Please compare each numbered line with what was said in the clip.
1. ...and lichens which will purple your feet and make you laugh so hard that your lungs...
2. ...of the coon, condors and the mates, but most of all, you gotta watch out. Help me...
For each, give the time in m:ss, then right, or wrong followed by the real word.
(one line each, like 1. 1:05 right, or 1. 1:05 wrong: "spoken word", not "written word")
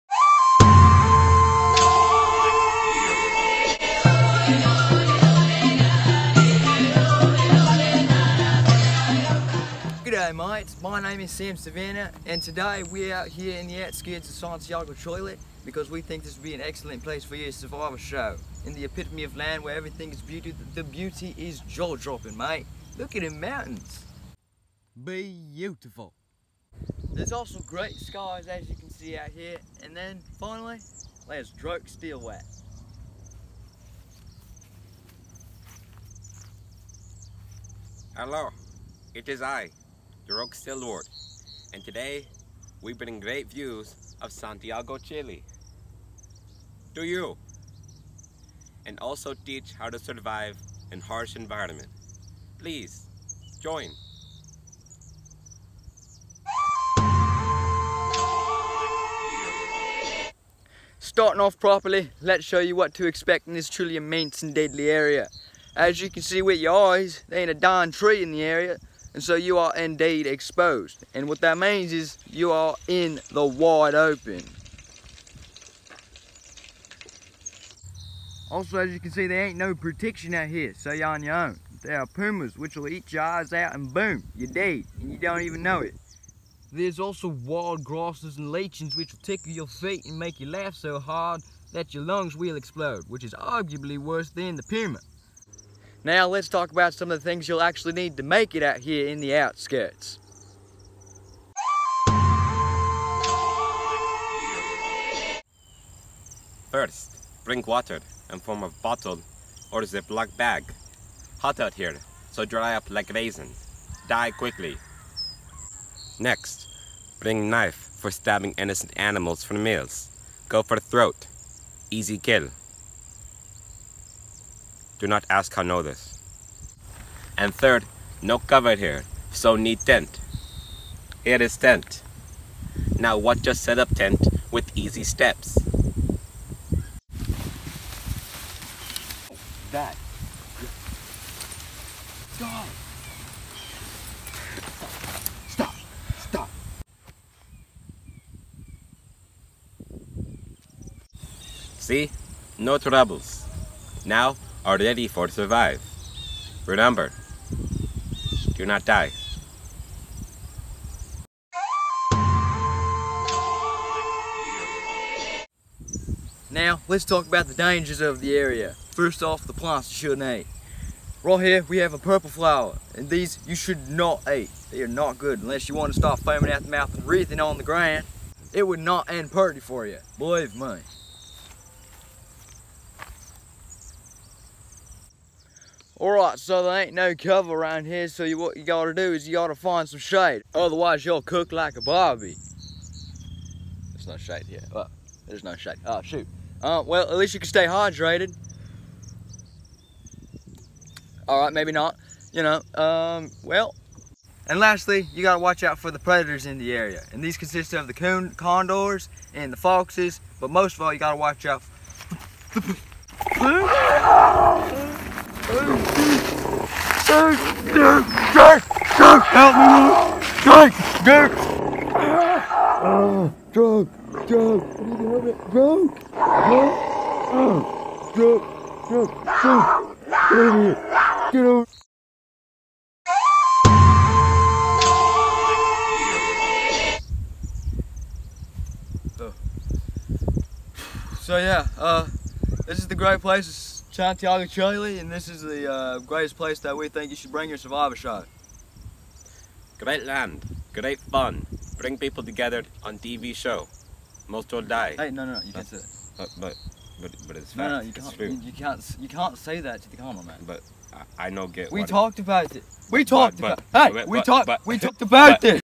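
1. 1:28 wrong: "tickle", not "purple"
2. 3:27 wrong: "foxes", not "mates".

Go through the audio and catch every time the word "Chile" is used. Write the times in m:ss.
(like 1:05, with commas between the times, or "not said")
0:14, 0:44, 4:04.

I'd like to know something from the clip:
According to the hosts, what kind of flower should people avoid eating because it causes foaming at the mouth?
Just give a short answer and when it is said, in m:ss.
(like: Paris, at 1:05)
Purple flower, at 2:51.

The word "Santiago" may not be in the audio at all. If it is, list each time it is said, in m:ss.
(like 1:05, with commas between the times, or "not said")
0:14, 0:44, 4:03.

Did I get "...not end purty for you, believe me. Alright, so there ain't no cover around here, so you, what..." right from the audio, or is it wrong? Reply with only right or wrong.
right.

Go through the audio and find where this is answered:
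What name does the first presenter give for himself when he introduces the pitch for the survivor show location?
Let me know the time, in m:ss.
0:11.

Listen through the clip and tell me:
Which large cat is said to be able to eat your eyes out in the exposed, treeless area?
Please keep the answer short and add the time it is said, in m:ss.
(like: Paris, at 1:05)
Pumas, at 1:22.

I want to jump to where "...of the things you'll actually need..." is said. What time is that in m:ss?
1:37.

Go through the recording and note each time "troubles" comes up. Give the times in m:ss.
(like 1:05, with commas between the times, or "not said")
2:32.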